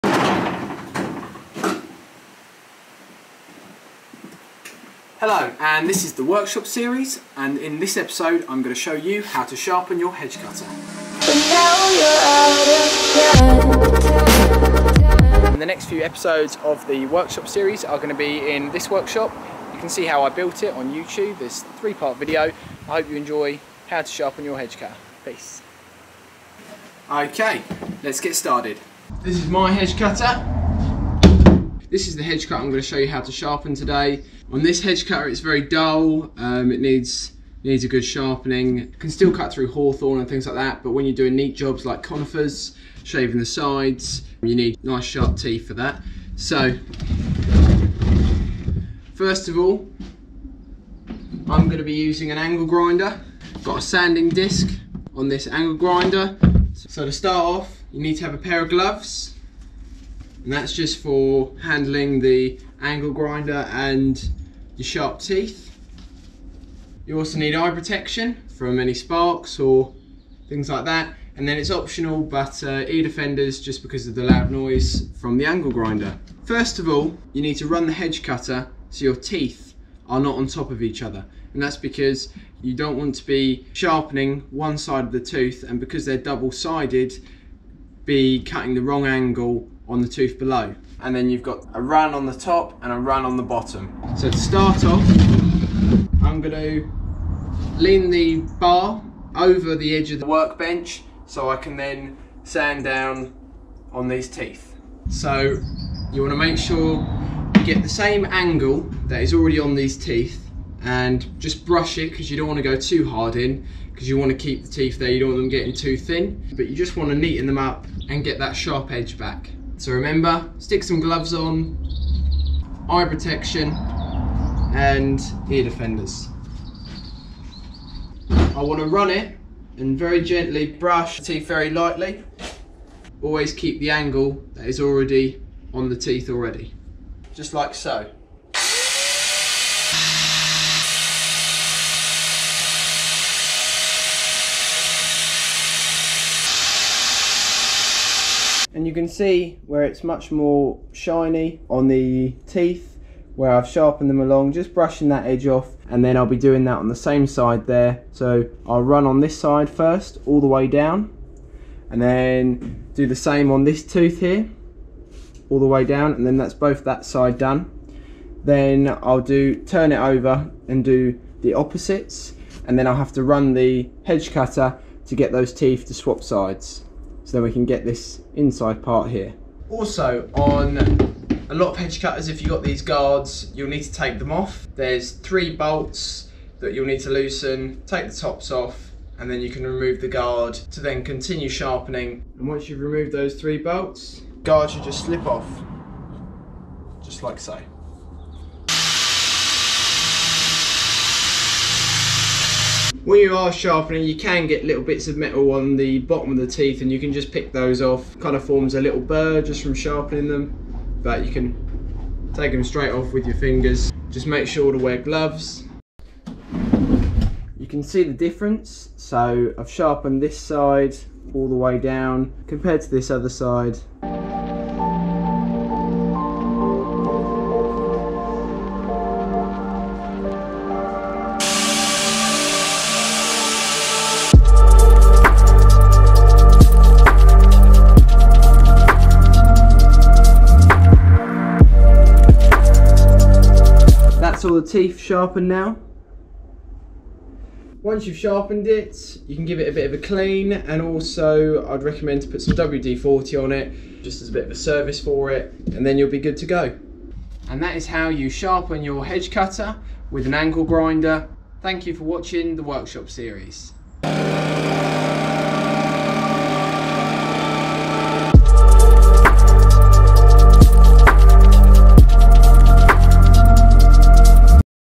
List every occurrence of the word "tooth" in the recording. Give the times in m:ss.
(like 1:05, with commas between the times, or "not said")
1:25, 1:30, 2:43.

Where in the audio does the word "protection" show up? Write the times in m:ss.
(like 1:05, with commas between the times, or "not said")
1:07, 2:03.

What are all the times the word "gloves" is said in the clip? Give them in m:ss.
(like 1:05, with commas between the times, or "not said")
0:58, 2:00, 3:34.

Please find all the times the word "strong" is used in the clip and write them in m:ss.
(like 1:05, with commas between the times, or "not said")
not said.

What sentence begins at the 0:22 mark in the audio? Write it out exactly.
I hope you enjoy how to sharpen your hedge cutter.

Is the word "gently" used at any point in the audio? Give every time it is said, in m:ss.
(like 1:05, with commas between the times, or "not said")
2:10.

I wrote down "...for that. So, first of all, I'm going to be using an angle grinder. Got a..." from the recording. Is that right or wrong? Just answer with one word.
right.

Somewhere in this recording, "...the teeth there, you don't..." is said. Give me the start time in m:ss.
1:54.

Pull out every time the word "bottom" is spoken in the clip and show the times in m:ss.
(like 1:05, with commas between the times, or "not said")
1:33, 3:25.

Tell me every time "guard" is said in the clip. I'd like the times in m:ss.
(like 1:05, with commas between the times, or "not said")
3:02, 3:10, 3:14.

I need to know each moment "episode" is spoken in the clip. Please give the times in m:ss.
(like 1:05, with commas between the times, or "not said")
0:07, 0:16.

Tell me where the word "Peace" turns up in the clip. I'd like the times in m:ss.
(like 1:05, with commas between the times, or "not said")
0:25.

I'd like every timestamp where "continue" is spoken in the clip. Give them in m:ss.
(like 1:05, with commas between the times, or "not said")
3:11.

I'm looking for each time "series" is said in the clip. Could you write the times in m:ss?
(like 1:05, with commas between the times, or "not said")
0:06, 0:17, 4:23.